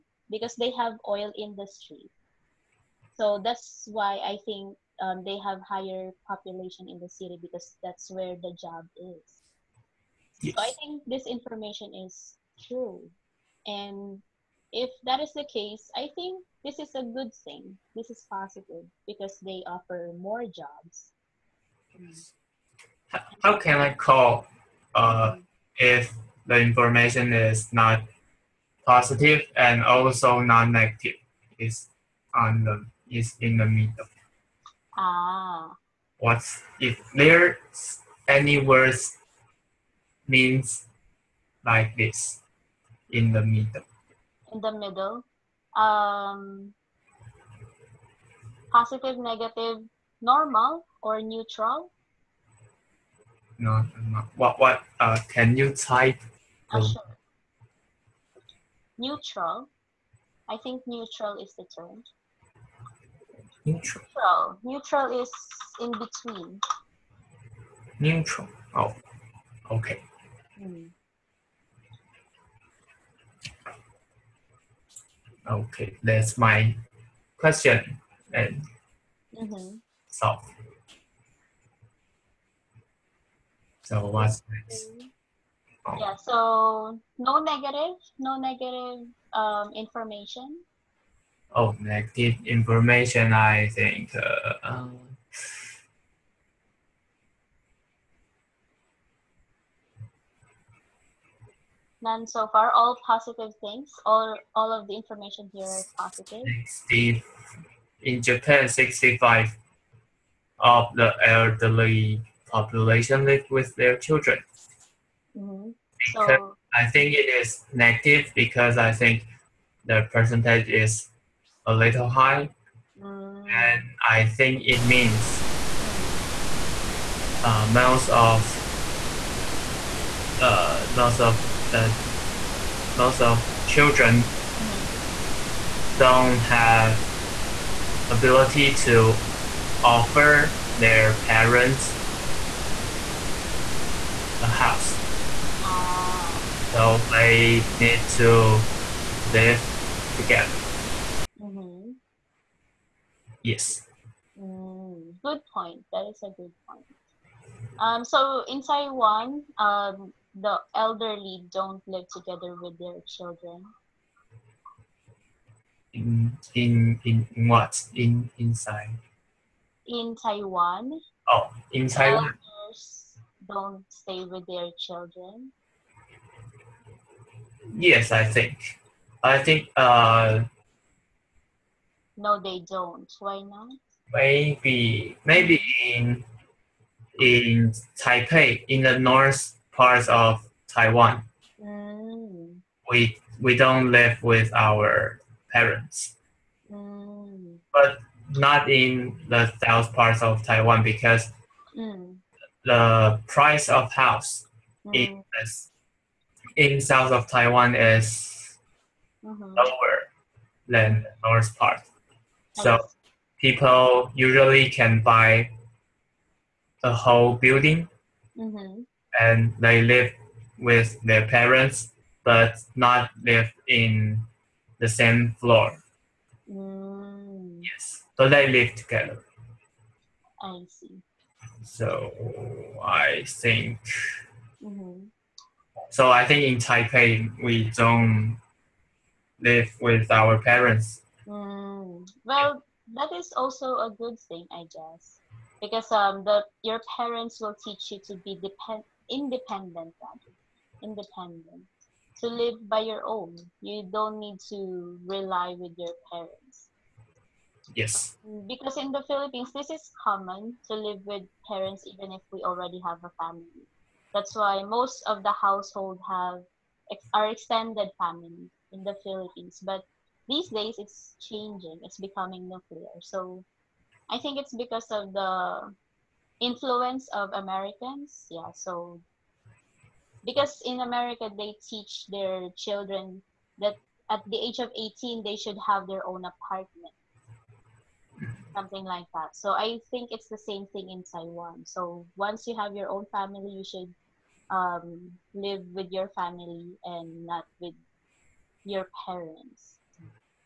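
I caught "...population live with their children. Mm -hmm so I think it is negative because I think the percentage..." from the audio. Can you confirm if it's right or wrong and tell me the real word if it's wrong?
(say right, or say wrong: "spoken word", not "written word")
right.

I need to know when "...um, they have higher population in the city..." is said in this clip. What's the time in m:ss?
0:05.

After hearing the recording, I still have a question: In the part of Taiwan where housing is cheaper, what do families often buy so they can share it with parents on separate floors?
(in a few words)
a whole building.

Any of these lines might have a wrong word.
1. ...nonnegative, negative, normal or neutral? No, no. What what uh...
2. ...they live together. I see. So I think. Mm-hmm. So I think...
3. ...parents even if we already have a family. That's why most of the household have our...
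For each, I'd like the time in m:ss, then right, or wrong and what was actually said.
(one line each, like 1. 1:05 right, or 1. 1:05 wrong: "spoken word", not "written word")
1. 0:48 wrong: "positive", not "nonnegative"
2. 3:48 right
3. 4:21 right.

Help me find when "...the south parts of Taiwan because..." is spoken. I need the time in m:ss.
3:19.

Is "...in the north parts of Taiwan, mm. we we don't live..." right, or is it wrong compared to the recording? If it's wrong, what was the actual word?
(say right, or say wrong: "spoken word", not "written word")
right.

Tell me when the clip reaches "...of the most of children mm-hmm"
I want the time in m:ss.
2:11.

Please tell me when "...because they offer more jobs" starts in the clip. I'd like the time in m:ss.
0:19.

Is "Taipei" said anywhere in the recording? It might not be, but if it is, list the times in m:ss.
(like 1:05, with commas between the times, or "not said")
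3:07, 3:56.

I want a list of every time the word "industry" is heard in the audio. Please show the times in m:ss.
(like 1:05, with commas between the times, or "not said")
0:01.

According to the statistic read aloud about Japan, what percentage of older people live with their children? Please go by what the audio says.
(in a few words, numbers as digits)
65.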